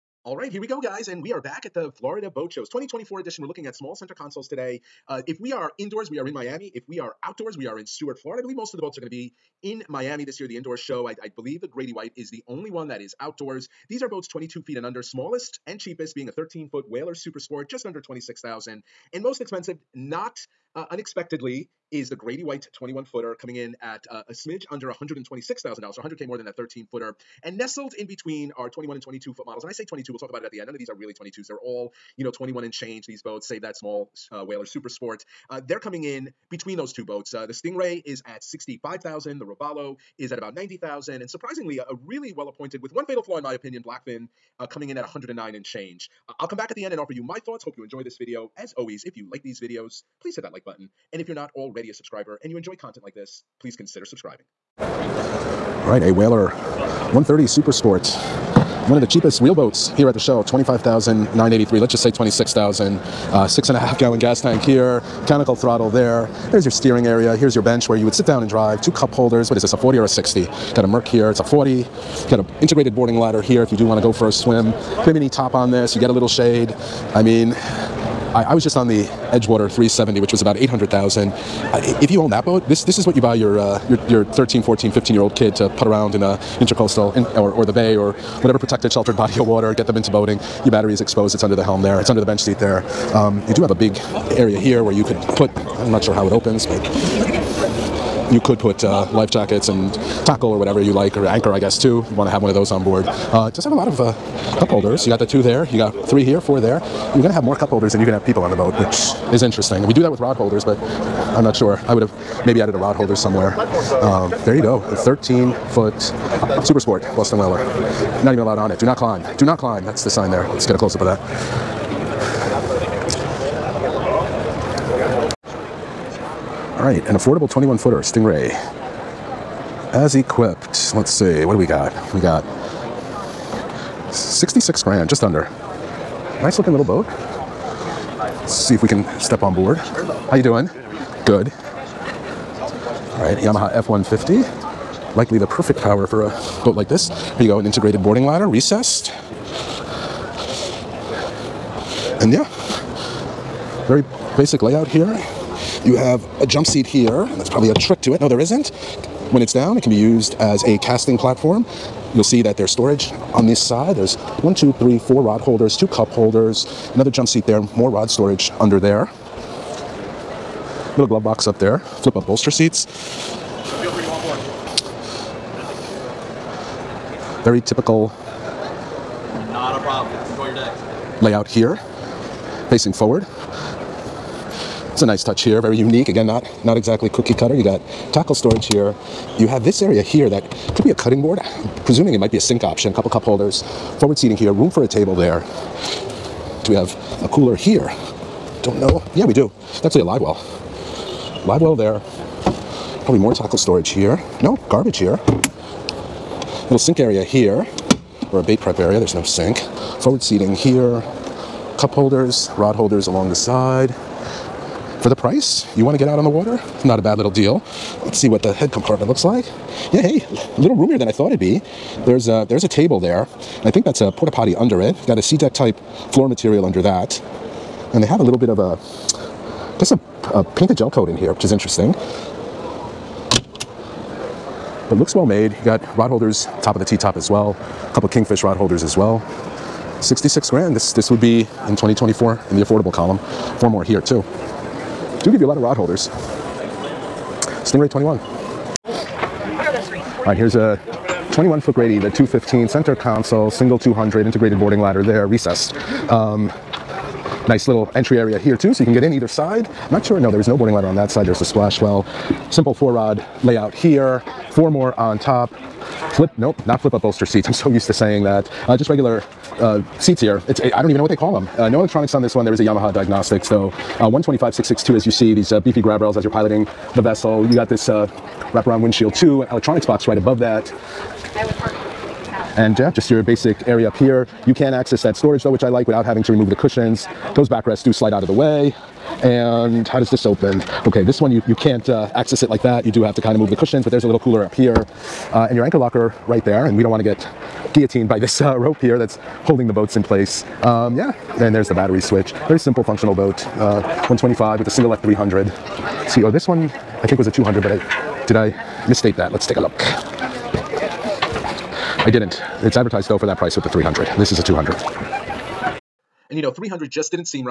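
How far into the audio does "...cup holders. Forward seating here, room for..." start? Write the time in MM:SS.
03:13.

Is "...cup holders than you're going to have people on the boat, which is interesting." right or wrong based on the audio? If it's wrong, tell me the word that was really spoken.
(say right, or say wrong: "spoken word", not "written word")
right.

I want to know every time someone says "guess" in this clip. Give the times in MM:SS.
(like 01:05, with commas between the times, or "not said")
01:41, 03:49.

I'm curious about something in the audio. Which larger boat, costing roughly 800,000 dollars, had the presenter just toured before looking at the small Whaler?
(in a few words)
Edgewater 370.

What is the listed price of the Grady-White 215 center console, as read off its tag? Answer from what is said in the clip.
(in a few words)
$125,662.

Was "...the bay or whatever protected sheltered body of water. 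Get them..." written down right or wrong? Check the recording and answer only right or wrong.
right.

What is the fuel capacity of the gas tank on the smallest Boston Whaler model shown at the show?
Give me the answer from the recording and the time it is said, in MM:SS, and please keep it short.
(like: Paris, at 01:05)
6.5 gallons, at 01:03.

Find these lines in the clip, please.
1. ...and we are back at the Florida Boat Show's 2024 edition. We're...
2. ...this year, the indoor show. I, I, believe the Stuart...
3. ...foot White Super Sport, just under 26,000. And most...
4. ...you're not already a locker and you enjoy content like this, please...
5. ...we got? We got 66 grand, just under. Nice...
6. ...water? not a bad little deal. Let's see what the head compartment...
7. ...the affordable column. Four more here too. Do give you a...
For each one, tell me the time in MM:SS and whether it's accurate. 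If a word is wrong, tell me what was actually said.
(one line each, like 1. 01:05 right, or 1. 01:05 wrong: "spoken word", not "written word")
1. 00:01 right
2. 00:10 wrong: "Grady", not "Stuart"
3. 00:16 wrong: "Whaler", not "White"
4. 00:51 wrong: "subscriber", not "locker"
5. 02:11 right
6. 03:36 right
7. 04:02 right.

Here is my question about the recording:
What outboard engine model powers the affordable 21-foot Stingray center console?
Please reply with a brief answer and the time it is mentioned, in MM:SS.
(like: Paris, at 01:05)
Yamaha F-150, at 02:23.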